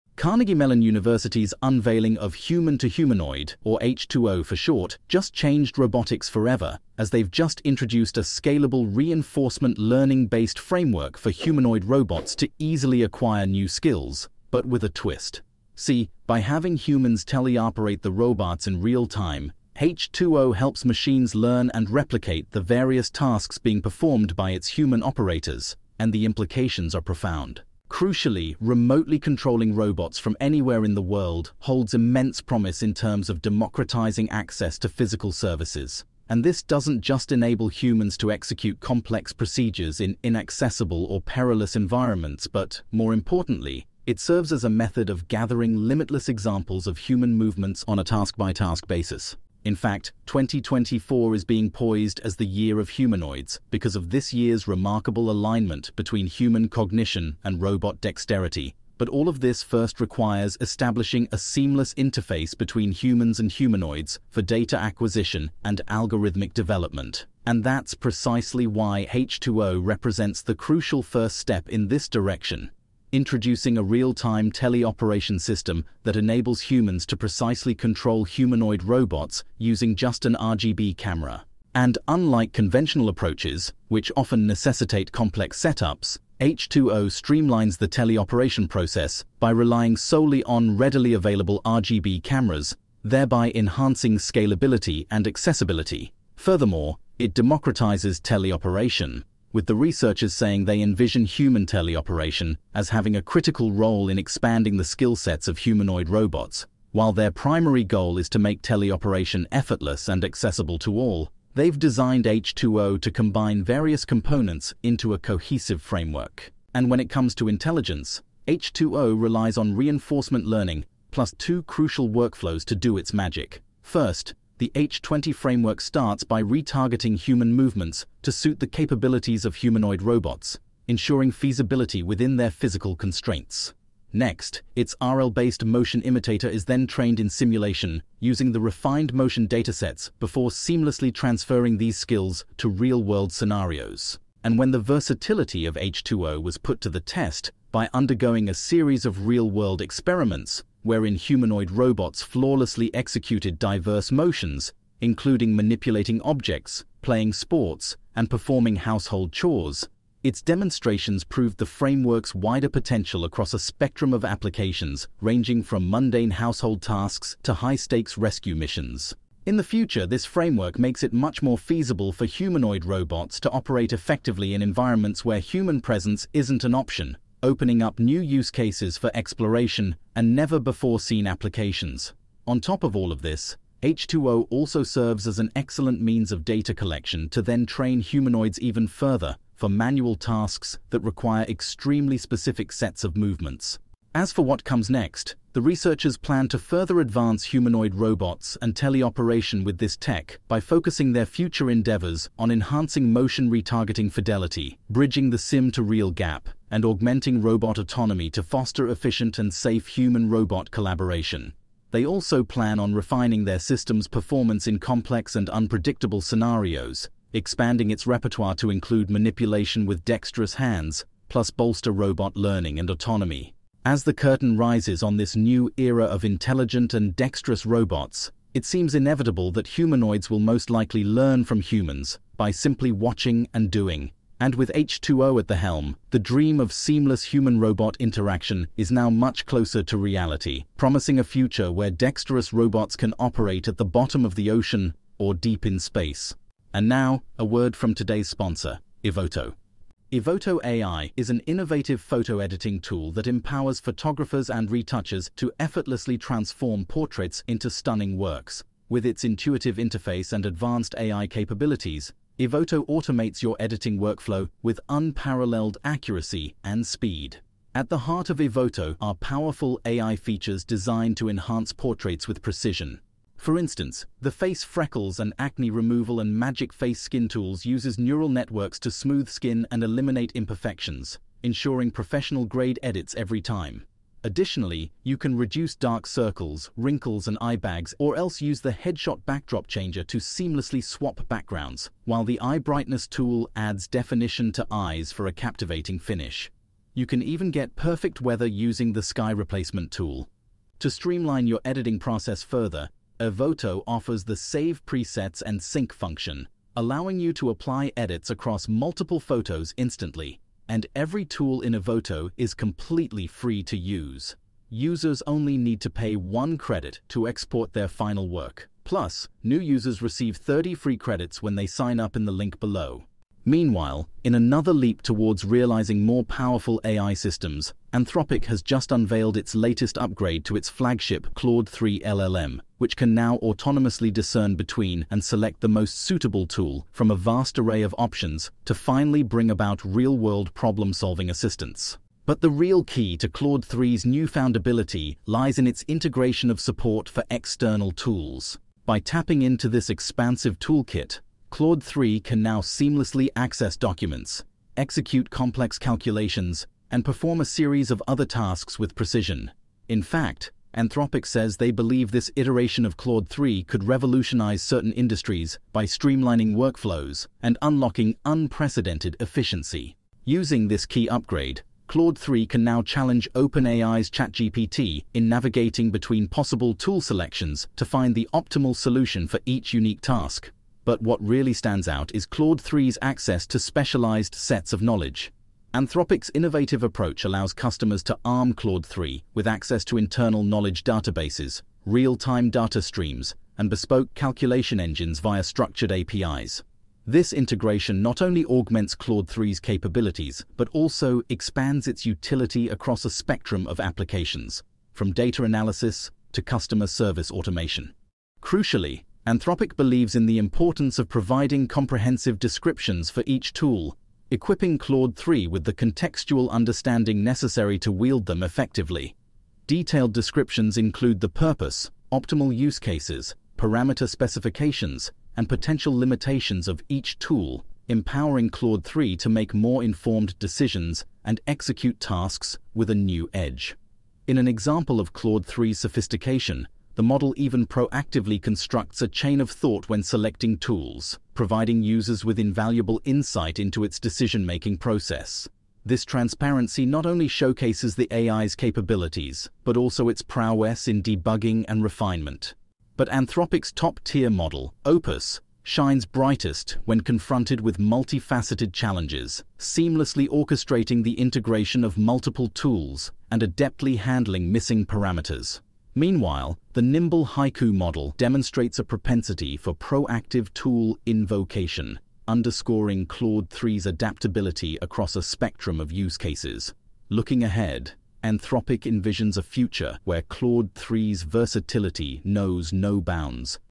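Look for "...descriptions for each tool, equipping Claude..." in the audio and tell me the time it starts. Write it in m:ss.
6:52.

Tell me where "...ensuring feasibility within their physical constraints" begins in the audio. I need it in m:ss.
2:10.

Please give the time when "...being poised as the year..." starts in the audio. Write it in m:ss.
0:51.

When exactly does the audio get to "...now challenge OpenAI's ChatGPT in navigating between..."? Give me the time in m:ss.
6:12.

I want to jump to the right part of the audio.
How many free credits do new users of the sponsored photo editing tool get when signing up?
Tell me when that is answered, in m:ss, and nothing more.
5:20.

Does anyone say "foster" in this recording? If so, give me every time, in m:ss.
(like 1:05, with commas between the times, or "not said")
3:28.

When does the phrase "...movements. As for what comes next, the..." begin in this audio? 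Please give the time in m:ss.
3:13.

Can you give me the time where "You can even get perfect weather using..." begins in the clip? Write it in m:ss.
4:56.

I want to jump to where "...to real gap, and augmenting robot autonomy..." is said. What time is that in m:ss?
3:25.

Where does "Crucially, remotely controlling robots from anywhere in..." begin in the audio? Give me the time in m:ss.
0:27.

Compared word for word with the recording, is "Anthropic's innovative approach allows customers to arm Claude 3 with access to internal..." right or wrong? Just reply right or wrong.
right.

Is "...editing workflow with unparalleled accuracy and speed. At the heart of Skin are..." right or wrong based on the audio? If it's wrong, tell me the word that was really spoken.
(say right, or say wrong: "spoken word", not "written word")
wrong: "Evoto", not "Skin".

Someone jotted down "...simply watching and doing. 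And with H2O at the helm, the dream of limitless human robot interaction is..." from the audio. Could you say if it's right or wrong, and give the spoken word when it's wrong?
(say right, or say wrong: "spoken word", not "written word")
wrong: "seamless", not "limitless".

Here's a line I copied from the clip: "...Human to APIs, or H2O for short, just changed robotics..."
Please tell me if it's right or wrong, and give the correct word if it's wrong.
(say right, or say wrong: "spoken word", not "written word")
wrong: "Humanoid", not "APIs".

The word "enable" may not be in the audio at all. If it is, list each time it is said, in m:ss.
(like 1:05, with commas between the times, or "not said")
0:37, 1:16.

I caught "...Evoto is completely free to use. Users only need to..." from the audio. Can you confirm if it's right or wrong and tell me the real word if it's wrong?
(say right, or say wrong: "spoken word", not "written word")
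right.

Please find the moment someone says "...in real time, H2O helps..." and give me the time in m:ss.
0:18.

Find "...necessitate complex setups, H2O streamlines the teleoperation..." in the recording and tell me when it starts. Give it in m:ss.
1:24.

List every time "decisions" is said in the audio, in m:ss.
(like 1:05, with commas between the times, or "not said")
7:10, 7:23.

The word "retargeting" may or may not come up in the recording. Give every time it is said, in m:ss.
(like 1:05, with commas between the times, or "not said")
2:06, 3:23.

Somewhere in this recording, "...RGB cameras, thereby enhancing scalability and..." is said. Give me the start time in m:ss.
1:31.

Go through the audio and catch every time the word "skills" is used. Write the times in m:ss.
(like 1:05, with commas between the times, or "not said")
0:13, 1:44, 2:21.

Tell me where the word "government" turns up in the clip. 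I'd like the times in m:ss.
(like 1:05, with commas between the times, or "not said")
not said.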